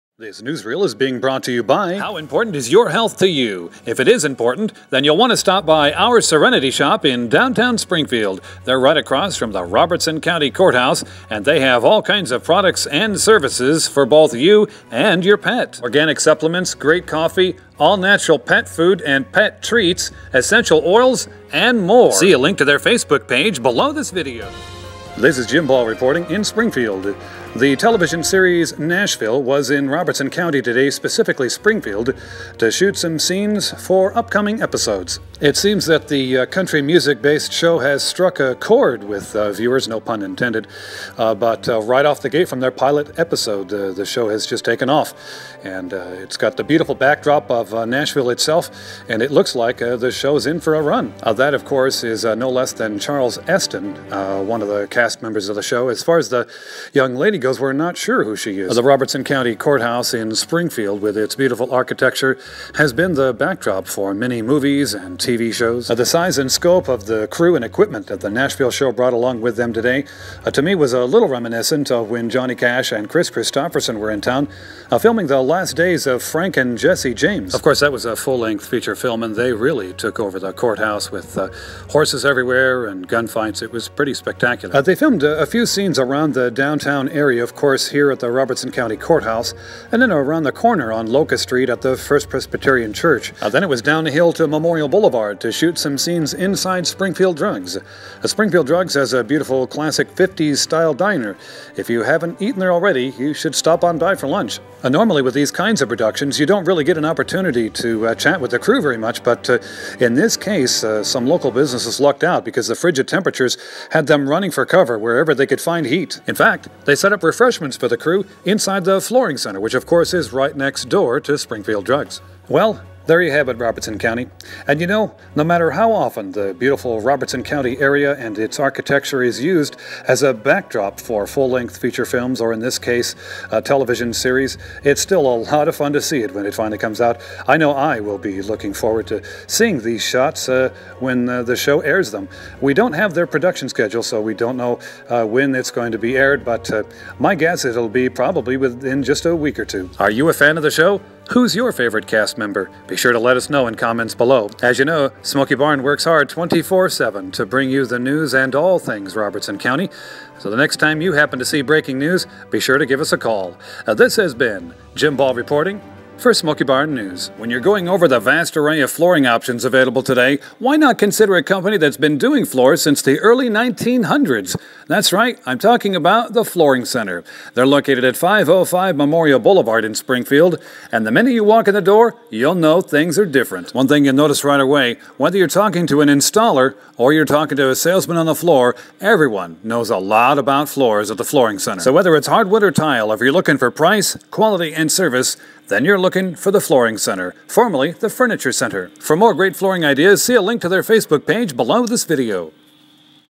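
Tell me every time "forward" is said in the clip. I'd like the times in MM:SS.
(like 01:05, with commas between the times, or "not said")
02:18.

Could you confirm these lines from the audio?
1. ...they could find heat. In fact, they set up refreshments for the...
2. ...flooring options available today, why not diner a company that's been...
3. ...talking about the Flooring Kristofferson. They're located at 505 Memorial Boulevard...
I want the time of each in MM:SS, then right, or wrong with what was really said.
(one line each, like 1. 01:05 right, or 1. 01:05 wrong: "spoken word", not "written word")
1. 01:55 right
2. 02:48 wrong: "consider", not "diner"
3. 02:55 wrong: "Center", not "Kristofferson".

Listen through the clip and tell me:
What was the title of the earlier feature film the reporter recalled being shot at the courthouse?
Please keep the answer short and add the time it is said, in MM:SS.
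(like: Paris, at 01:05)
The Last Days of Frank and Jesse James, at 01:15.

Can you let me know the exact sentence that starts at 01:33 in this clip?
Uh, then it was downhill to Memorial Boulevard to shoot some scenes inside Springfield Drugs.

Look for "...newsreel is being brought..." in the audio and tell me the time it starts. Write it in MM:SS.
00:00.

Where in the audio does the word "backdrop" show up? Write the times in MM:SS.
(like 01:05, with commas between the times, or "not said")
00:46, 01:03, 02:10.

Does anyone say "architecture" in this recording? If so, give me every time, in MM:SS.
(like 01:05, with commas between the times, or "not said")
01:01, 02:08.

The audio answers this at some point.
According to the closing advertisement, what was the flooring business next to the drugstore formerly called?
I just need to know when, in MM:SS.
03:17.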